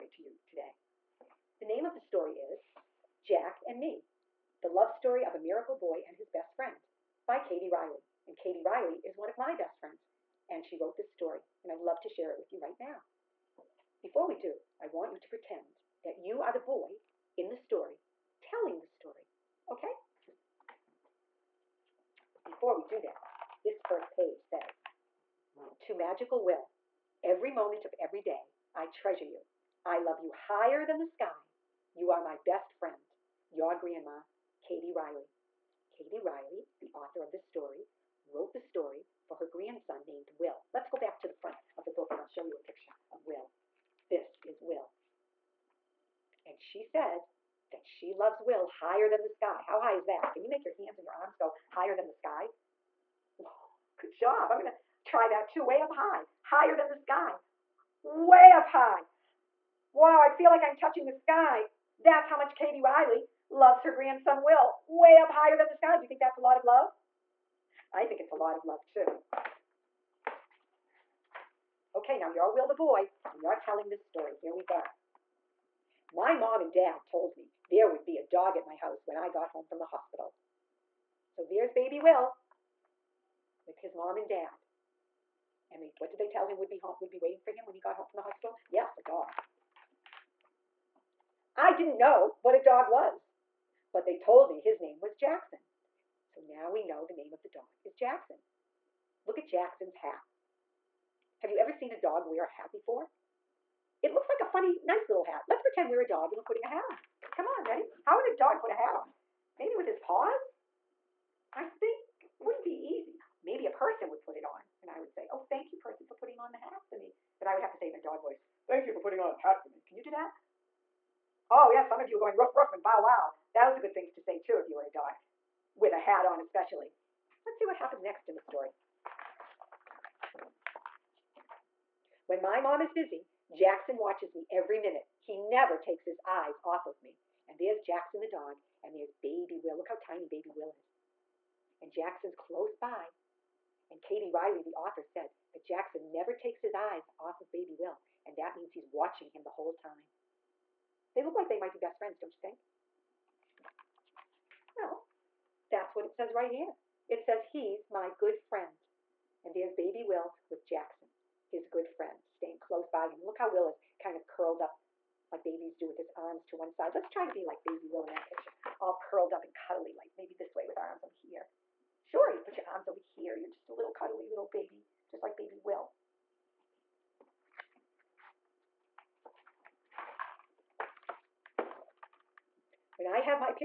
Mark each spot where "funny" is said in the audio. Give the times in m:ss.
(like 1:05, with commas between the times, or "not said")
1:44.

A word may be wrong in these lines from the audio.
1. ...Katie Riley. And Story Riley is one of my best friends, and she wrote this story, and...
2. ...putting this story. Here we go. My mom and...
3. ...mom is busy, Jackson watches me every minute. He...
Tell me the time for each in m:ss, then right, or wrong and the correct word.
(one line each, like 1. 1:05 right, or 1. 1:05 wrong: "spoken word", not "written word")
1. 0:07 wrong: "Katie", not "Story"
2. 1:13 wrong: "telling", not "putting"
3. 2:12 right.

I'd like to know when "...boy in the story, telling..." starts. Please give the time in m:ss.
0:16.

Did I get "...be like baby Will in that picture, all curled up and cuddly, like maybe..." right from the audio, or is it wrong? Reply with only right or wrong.
right.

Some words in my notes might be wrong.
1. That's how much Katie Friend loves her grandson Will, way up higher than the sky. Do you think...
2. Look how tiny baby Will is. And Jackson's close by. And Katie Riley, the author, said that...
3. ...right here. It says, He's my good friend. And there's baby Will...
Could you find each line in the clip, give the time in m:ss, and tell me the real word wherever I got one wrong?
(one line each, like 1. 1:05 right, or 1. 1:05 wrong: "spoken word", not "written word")
1. 1:01 wrong: "Riley", not "Friend"
2. 2:19 right
3. 2:36 right.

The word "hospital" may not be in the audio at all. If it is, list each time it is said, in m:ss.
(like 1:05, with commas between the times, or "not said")
1:19, 1:28.